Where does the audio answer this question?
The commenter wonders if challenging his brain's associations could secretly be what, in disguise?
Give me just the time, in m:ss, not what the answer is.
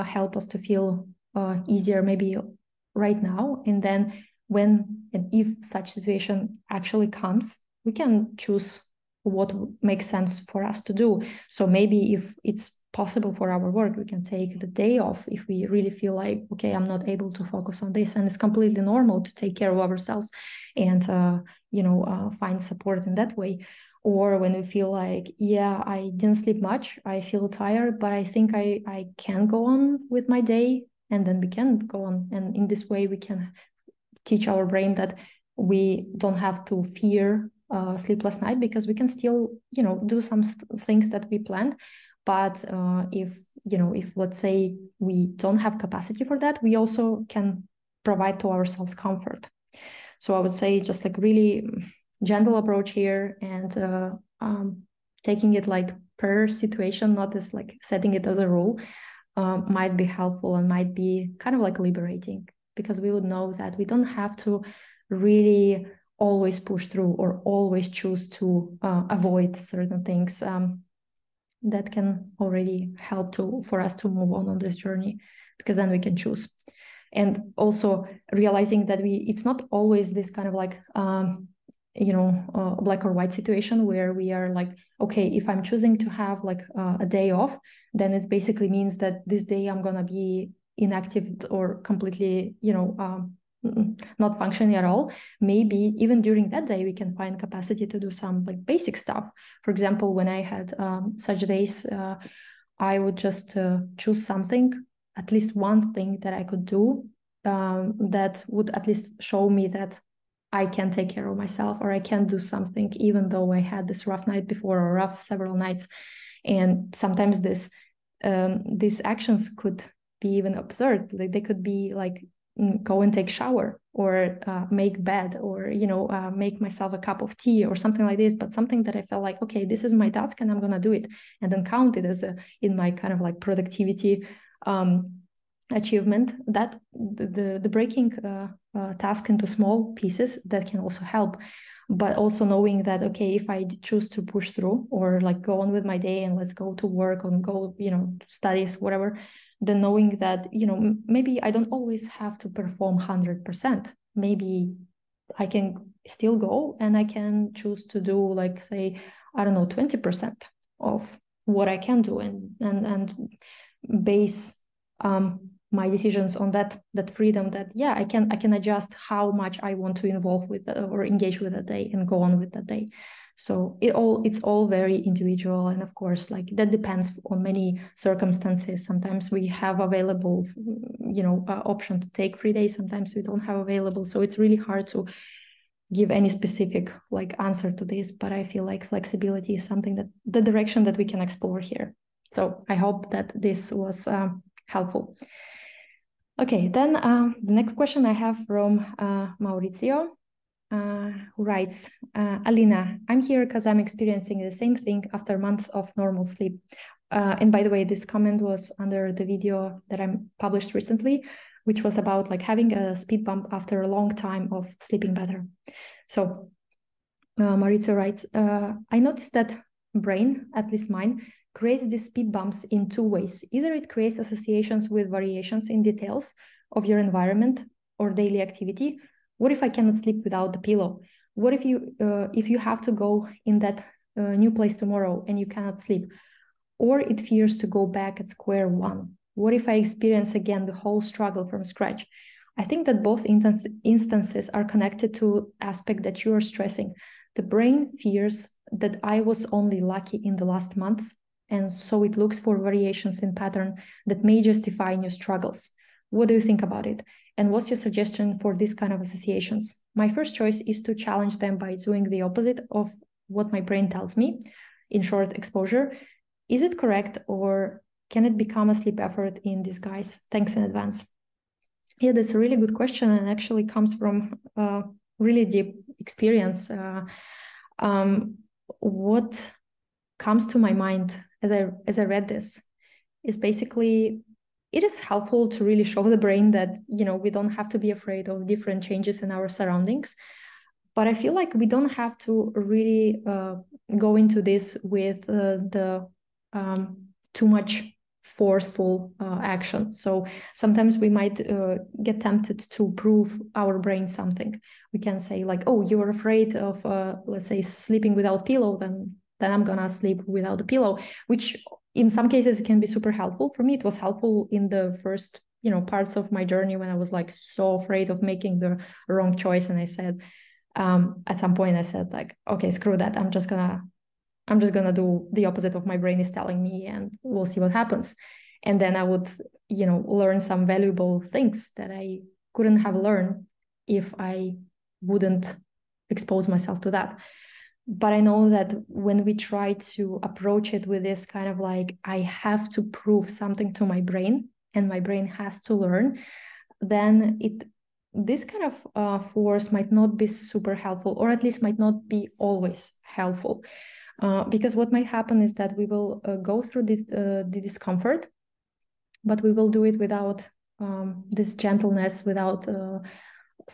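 4:28.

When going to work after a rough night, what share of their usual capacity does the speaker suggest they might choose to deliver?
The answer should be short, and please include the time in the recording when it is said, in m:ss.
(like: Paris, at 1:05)
20%, at 2:39.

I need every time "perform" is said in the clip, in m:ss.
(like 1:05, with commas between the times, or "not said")
2:32.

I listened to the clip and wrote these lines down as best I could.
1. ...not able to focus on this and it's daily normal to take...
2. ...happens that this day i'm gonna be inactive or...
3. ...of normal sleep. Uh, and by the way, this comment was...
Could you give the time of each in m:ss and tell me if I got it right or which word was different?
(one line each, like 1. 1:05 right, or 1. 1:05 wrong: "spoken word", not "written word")
1. 0:16 wrong: "completely", not "daily"
2. 1:28 wrong: "means", not "happens"
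3. 3:25 right.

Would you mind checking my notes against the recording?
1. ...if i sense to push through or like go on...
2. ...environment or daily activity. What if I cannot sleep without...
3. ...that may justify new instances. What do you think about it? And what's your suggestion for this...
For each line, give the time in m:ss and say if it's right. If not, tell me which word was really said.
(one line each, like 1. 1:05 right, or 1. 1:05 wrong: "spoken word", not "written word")
1. 2:23 wrong: "choose", not "sense"
2. 3:46 right
3. 4:14 wrong: "struggles", not "instances".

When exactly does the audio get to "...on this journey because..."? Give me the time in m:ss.
1:14.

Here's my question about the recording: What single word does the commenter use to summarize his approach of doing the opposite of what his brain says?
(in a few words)
exposure.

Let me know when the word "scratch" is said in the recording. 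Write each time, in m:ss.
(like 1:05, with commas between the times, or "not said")
4:01.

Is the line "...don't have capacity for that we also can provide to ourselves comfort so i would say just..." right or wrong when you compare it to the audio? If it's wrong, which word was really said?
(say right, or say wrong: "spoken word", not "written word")
right.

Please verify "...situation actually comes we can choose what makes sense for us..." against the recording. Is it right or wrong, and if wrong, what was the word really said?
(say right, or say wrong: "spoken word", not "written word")
right.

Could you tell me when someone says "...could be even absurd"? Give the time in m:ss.
1:59.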